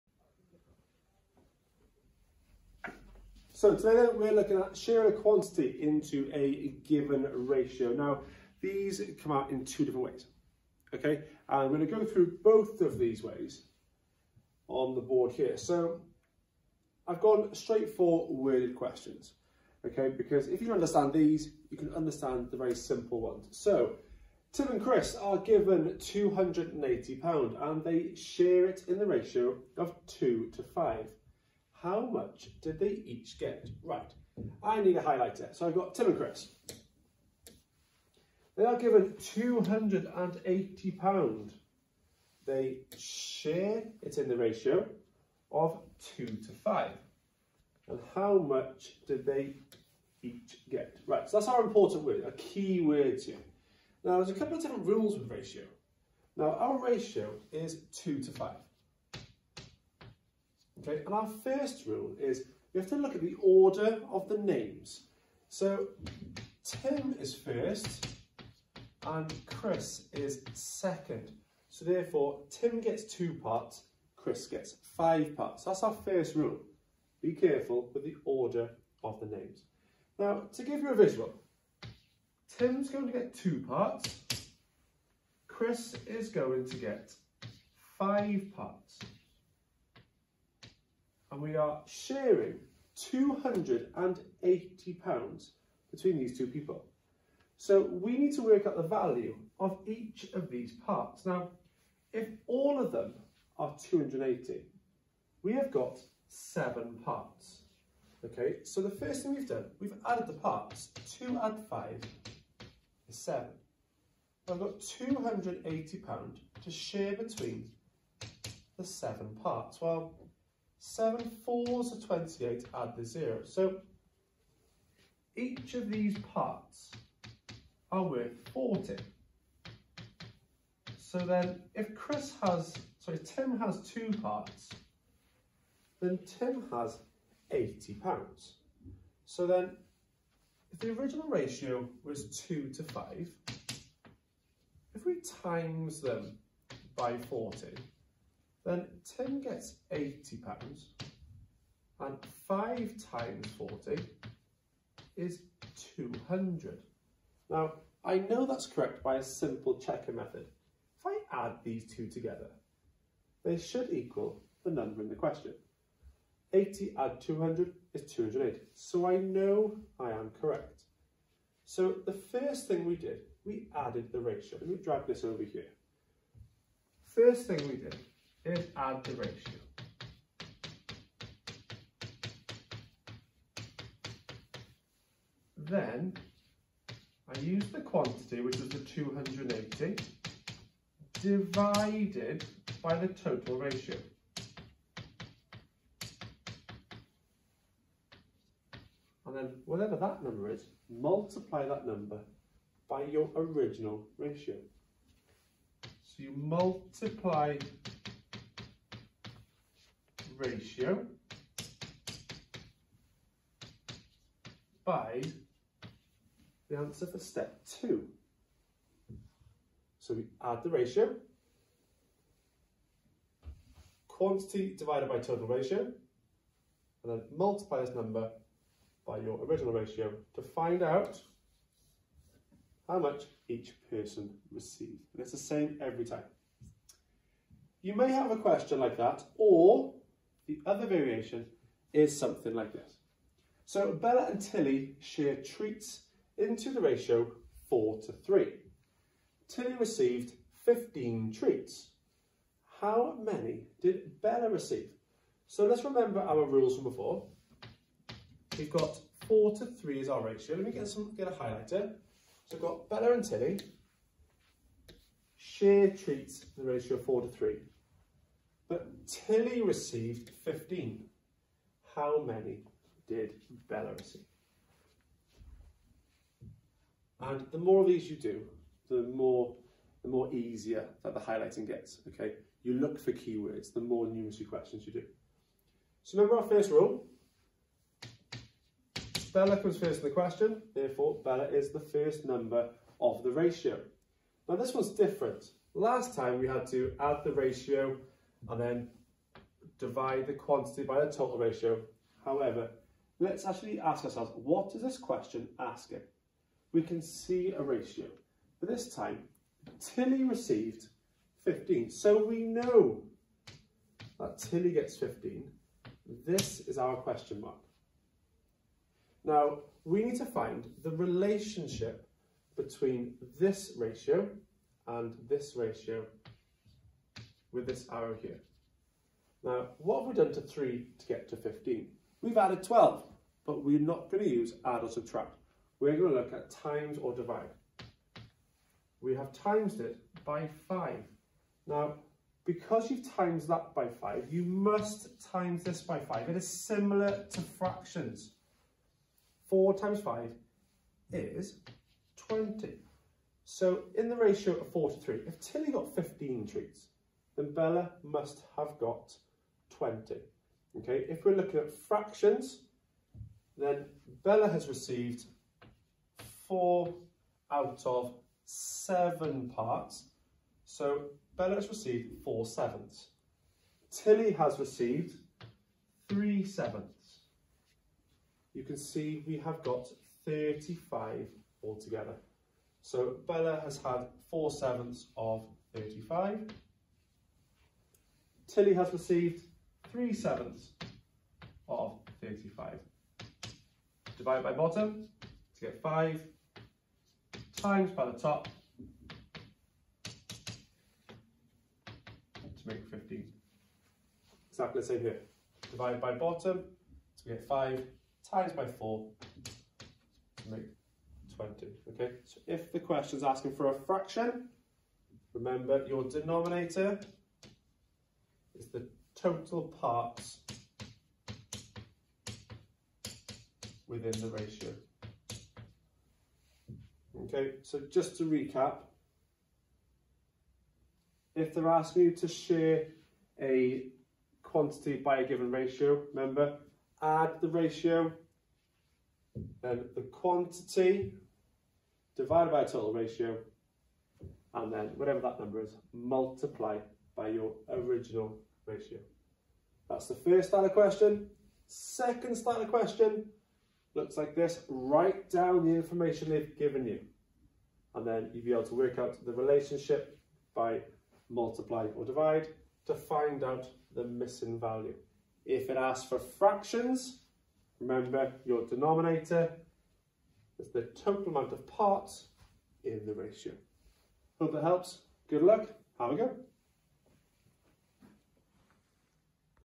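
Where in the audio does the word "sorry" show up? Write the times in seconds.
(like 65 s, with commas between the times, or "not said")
132 s.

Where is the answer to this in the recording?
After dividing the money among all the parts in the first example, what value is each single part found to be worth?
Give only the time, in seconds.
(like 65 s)
128 s.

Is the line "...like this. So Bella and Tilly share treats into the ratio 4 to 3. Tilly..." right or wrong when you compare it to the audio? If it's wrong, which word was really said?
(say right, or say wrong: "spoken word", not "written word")
right.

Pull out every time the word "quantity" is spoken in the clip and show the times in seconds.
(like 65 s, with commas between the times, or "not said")
5 s, 187 s, 224 s, 300 s, 434 s, 440 s.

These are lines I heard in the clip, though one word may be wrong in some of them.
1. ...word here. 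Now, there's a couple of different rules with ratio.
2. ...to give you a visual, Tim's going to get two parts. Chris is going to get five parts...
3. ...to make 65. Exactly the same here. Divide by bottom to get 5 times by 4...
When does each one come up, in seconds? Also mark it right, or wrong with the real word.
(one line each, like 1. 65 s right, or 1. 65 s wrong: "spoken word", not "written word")
1. 52 s right
2. 80 s right
3. 398 s wrong: "15", not "65".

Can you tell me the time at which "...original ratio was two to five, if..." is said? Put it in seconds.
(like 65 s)
140 s.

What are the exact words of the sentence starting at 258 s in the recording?
We've got 4 to 3 is our ratio.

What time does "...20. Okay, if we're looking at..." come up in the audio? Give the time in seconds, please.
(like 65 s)
359 s.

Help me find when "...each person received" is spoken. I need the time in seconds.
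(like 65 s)
233 s.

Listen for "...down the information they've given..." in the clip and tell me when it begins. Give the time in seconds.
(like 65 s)
455 s.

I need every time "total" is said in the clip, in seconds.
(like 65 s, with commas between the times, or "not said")
193 s, 225 s, 301 s, 419 s, 442 s, 471 s.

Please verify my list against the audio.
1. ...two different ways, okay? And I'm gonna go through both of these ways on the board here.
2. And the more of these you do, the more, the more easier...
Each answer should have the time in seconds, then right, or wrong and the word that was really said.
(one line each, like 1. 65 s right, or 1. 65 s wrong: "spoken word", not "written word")
1. 9 s right
2. 277 s right.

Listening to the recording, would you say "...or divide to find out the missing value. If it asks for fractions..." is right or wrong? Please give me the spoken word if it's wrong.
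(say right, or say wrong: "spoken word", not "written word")
right.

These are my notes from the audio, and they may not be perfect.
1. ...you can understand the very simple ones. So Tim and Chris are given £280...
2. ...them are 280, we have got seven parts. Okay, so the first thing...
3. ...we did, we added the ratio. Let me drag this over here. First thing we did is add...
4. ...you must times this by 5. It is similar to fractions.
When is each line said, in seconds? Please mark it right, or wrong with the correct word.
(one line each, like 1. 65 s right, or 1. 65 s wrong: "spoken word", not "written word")
1. 21 s right
2. 102 s right
3. 172 s right
4. 344 s right.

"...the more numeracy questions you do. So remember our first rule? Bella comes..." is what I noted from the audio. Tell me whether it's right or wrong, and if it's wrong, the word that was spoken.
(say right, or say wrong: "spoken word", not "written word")
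right.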